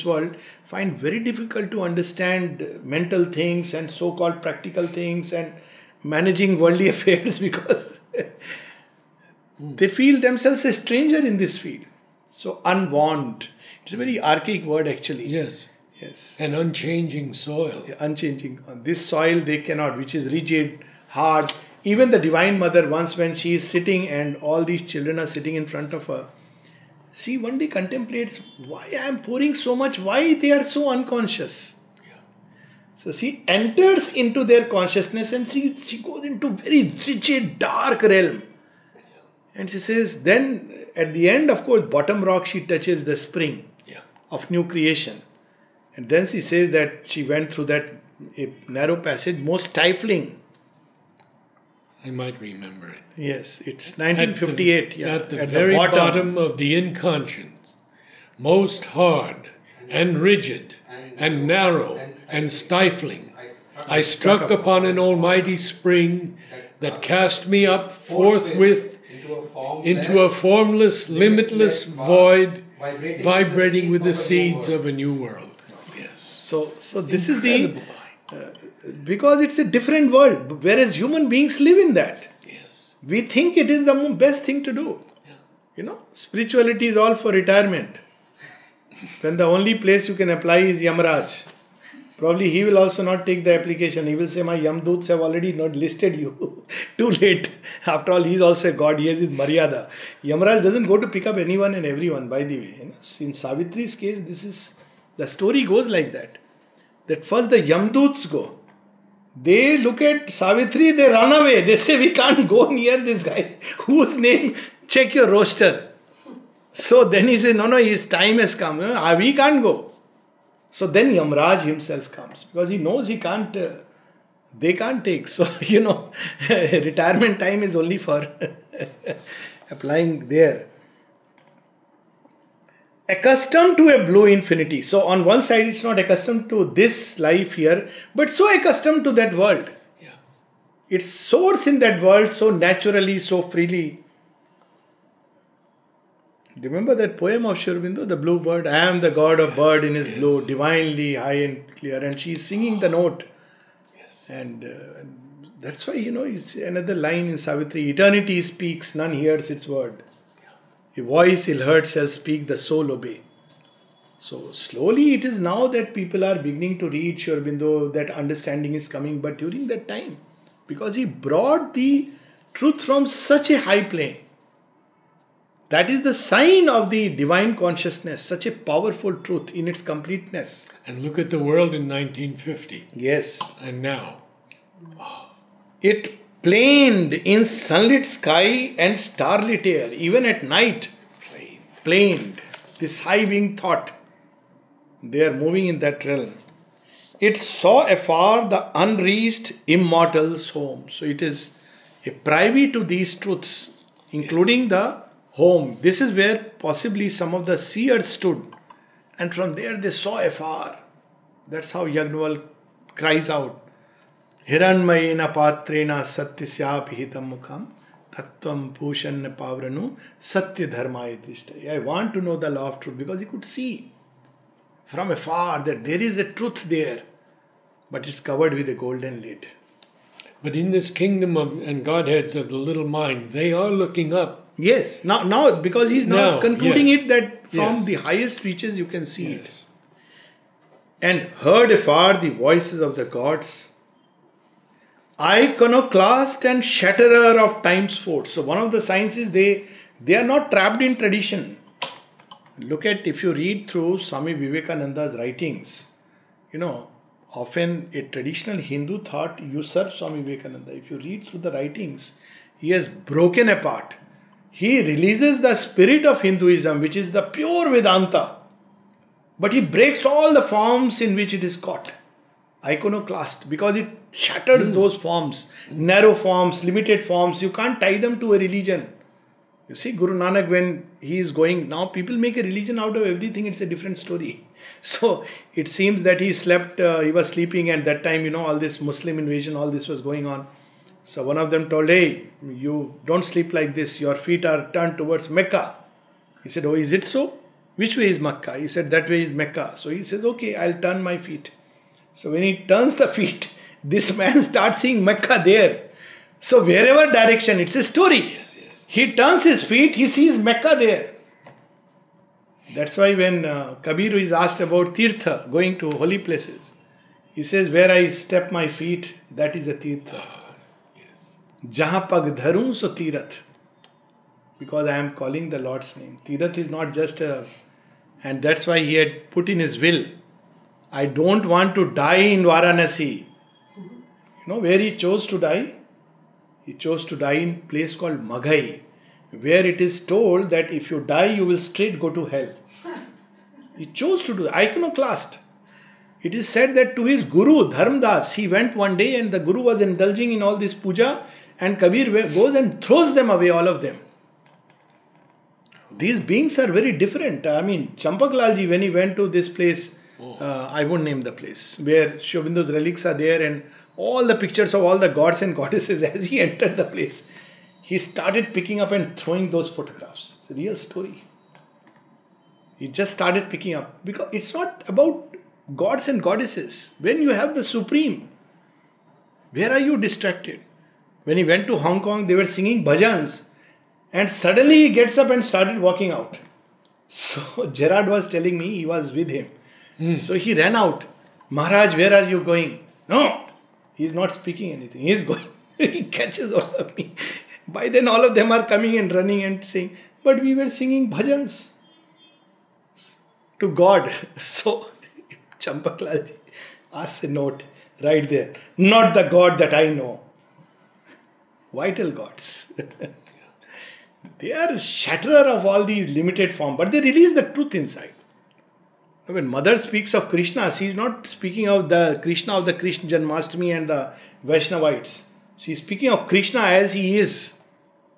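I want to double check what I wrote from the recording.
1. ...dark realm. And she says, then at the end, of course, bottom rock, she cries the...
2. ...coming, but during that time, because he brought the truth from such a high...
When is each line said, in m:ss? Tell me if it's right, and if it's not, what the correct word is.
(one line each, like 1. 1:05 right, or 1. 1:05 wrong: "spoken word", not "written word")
1. 0:37 wrong: "touches", not "cries"
2. 2:48 right.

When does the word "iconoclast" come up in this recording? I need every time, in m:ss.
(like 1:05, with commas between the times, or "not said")
4:05, 4:32, 5:44.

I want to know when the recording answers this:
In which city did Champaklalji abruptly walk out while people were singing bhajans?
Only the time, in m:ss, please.
6:21.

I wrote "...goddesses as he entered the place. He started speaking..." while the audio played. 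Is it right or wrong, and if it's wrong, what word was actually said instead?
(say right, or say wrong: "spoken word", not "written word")
wrong: "picking", not "speaking".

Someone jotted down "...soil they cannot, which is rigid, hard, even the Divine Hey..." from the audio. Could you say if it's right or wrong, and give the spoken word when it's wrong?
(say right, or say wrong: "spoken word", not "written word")
wrong: "Mother", not "Hey".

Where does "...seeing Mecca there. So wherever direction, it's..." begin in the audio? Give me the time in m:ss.
5:04.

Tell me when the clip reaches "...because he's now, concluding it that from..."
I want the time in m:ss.
3:55.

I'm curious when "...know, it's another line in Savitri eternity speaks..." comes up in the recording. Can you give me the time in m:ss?
2:36.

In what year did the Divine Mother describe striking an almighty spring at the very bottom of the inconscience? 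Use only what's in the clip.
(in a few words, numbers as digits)
1958.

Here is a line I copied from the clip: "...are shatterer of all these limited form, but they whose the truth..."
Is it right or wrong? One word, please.
wrong.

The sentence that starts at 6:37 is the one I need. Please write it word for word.
By then, all of them are coming and running and saying, But we were singing bhajans to God.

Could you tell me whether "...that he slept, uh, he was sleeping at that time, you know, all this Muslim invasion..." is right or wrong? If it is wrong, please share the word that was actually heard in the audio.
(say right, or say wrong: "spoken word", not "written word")
right.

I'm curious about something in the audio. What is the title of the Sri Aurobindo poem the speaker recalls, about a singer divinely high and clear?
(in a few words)
The blue bird.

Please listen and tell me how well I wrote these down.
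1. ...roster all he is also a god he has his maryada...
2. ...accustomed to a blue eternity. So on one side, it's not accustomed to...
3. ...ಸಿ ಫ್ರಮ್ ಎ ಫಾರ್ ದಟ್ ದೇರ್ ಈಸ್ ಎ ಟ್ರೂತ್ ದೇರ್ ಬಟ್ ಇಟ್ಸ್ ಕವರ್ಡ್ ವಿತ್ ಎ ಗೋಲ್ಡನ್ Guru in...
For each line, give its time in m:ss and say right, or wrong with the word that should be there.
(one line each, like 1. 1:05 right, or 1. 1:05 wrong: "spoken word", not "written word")
1. 1:37 wrong: "after", not "roster"
2. 2:13 wrong: "infinity", not "eternity"
3. 3:43 wrong: "But", not "Guru".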